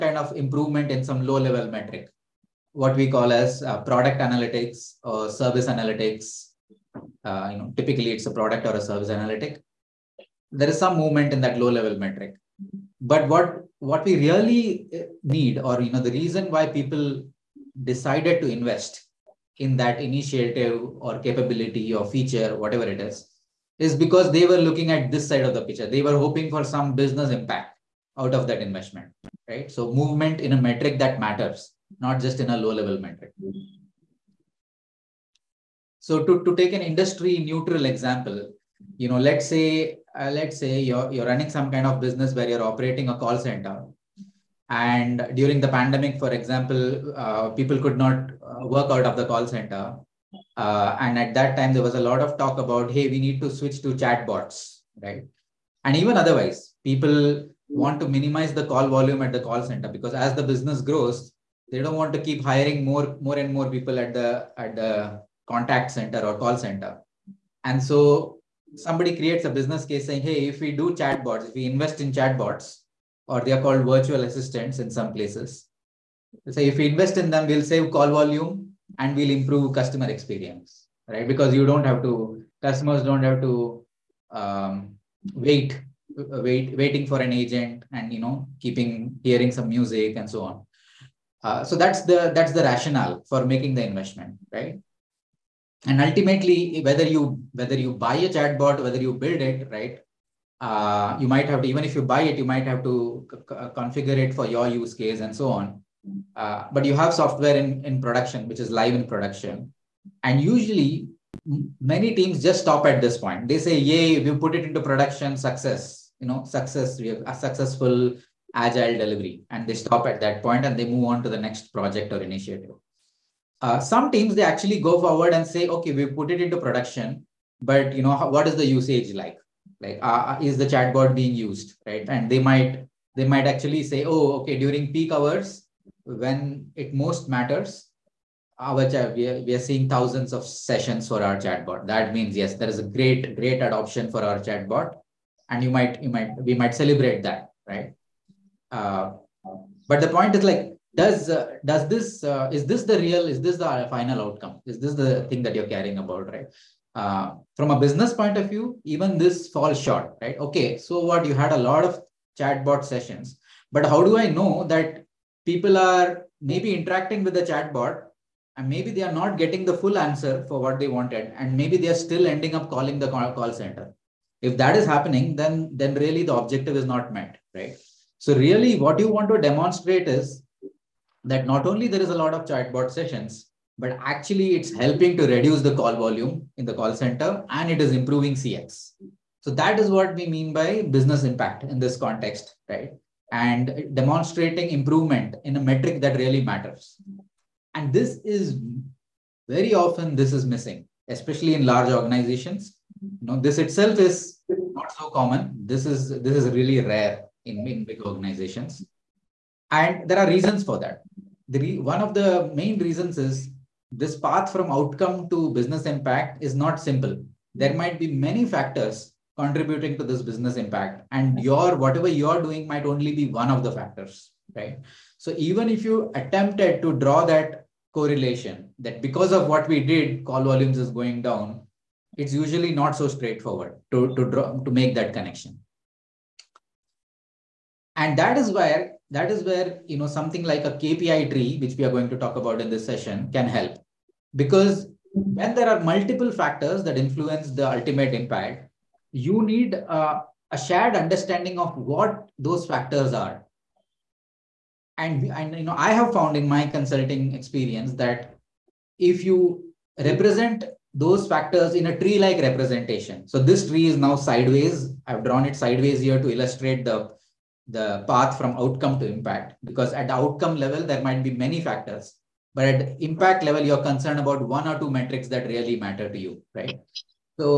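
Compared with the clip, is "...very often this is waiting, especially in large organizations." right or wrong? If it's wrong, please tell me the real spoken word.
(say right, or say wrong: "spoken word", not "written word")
wrong: "missing", not "waiting".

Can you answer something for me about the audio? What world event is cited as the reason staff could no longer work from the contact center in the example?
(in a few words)
the pandemic.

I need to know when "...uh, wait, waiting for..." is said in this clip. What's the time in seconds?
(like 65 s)
86 s.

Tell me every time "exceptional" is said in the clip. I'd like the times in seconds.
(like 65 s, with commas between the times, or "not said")
not said.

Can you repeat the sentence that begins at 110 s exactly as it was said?
And usually, many teams just stop at this point.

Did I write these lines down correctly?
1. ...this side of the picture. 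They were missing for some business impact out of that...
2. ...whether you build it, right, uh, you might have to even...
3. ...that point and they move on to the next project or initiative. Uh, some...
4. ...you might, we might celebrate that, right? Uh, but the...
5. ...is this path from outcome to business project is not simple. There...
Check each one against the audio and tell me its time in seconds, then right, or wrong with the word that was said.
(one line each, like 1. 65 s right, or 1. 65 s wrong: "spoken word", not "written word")
1. 25 s wrong: "hoping", not "missing"
2. 98 s right
3. 120 s right
4. 146 s right
5. 213 s wrong: "impact", not "project".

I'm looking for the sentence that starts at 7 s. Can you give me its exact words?
Uh, you know, typically it's a product or a service analytic.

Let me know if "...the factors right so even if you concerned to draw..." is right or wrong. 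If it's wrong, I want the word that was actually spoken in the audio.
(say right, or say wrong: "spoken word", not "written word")
wrong: "attempted", not "concerned".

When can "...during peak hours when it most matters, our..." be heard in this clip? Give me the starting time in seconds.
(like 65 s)
134 s.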